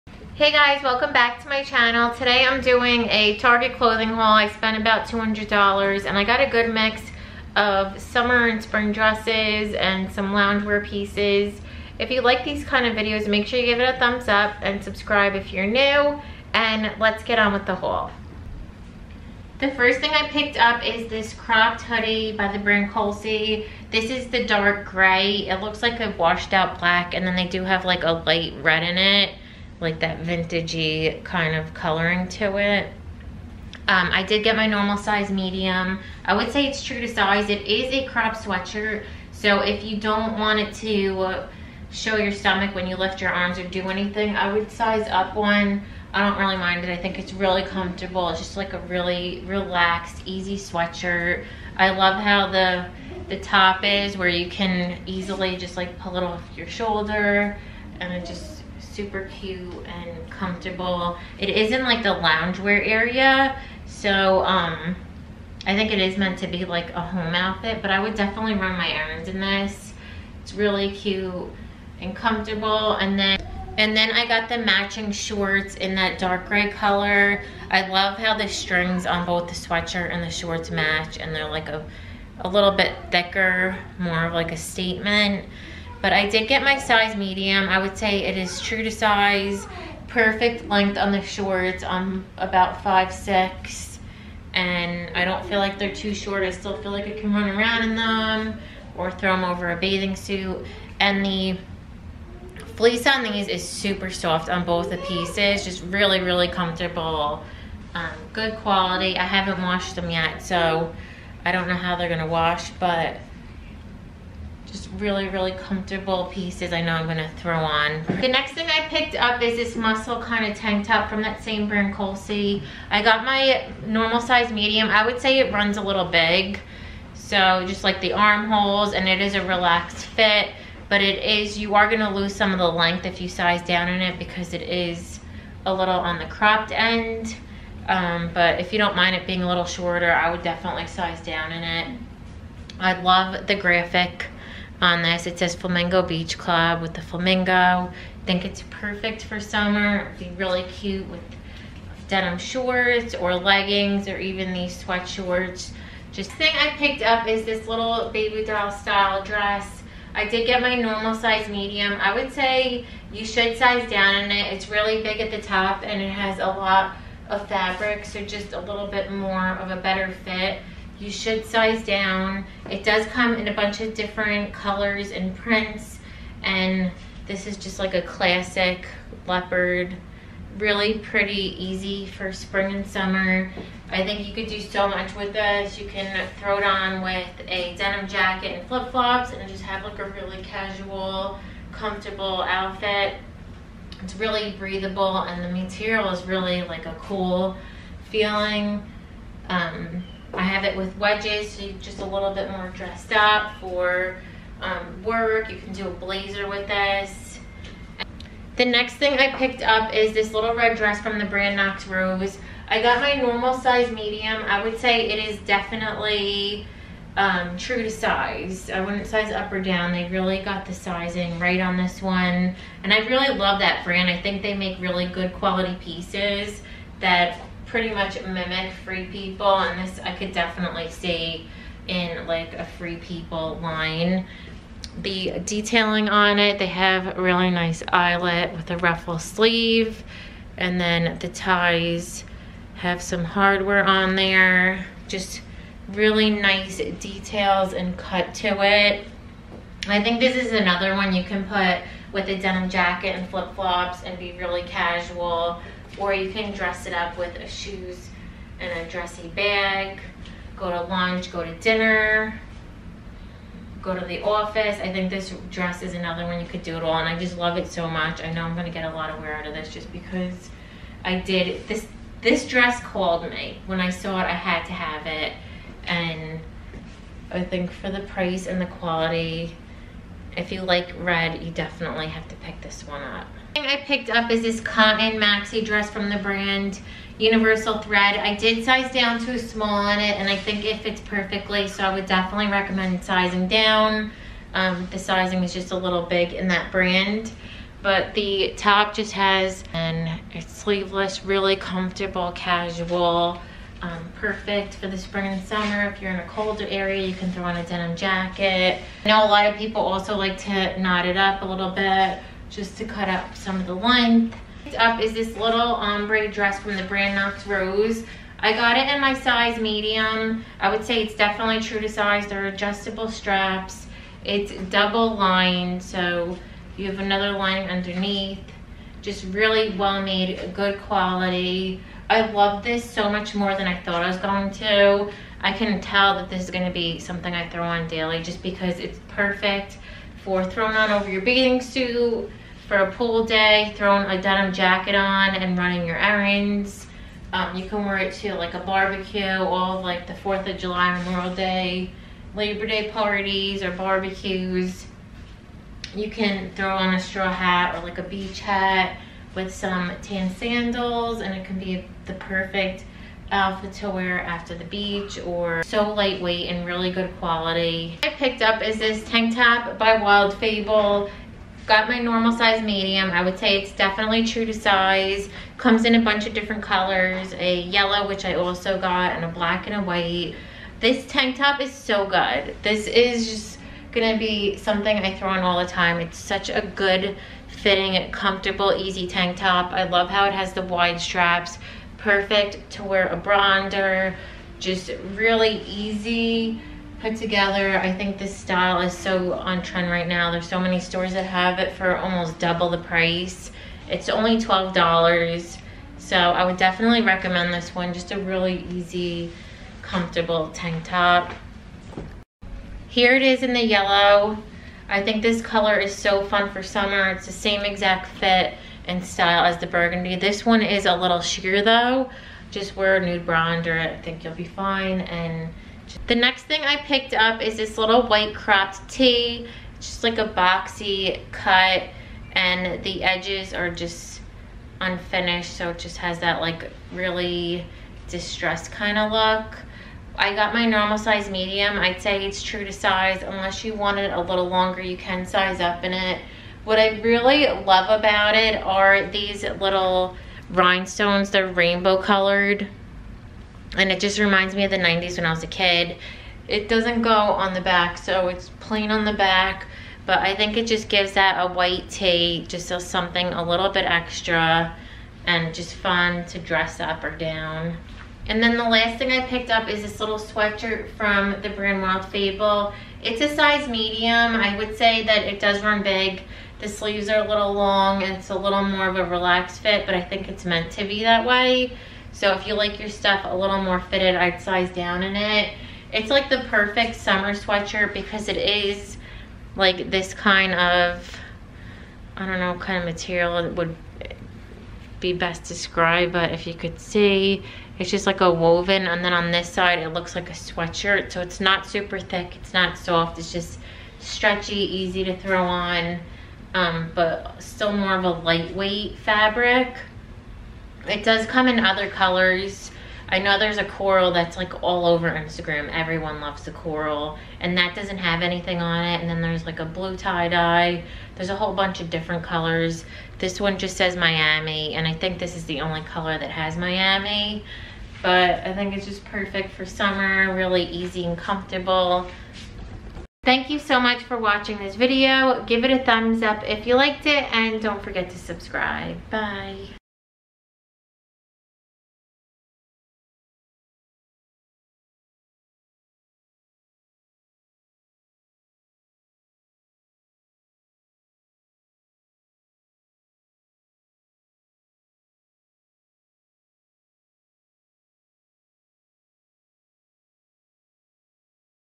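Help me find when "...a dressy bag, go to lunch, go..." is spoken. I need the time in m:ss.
4:18.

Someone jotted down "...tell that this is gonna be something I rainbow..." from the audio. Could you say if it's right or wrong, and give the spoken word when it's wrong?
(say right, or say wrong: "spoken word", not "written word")
wrong: "throw", not "rainbow".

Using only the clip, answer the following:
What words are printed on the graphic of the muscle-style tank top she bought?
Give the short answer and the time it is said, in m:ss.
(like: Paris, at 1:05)
Flamingo Beach Club, at 2:25.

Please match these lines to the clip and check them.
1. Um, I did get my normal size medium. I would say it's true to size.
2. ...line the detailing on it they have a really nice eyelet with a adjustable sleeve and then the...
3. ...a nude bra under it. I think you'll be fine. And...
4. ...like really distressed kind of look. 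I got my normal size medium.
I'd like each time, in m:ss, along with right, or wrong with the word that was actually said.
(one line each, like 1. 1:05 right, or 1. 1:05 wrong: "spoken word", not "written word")
1. 0:33 right
2. 3:53 wrong: "ruffle", not "adjustable"
3. 7:02 right
4. 7:16 right.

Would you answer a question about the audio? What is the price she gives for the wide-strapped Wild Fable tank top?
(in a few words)
$12.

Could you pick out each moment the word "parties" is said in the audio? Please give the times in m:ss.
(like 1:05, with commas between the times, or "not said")
5:52.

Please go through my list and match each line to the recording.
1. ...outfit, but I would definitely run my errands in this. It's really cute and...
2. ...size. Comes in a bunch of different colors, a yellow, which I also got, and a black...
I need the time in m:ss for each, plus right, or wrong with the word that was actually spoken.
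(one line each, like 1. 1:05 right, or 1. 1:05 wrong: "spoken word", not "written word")
1. 1:07 right
2. 6:14 right.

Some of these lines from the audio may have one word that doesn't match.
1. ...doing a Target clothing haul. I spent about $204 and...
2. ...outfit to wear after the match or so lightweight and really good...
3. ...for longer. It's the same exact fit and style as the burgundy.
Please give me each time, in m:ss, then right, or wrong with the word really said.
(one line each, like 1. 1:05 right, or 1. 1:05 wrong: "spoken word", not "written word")
1. 0:02 wrong: "200", not "204"
2. 6:03 wrong: "beach", not "match"
3. 6:56 wrong: "summer", not "longer".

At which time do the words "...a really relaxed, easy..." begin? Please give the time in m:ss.
0:48.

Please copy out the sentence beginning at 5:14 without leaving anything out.
Next up is this little ombre dress from the brand Knox Rose.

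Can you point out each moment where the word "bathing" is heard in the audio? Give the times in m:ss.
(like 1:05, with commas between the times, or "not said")
1:39, 5:41.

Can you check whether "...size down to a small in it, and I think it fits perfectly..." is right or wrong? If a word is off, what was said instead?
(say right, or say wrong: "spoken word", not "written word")
right.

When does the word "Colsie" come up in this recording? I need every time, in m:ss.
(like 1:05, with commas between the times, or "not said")
0:22, 2:01.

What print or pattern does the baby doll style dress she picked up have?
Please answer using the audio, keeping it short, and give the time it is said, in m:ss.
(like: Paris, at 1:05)
Leopard, at 2:59.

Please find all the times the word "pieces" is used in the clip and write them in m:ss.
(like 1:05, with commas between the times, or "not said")
0:10, 1:44, 1:56, 3:45.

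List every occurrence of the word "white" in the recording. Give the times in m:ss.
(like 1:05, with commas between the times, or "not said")
6:19, 7:08, 7:41.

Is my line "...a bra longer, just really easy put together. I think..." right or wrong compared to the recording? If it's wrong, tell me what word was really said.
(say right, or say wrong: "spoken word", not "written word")
wrong: "under", not "longer".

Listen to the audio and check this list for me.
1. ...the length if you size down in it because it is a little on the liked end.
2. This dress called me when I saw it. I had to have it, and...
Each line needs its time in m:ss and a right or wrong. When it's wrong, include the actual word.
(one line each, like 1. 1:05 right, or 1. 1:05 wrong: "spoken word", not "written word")
1. 2:12 wrong: "cropped", not "liked"
2. 4:32 right.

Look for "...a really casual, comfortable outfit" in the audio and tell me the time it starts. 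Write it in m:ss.
3:09.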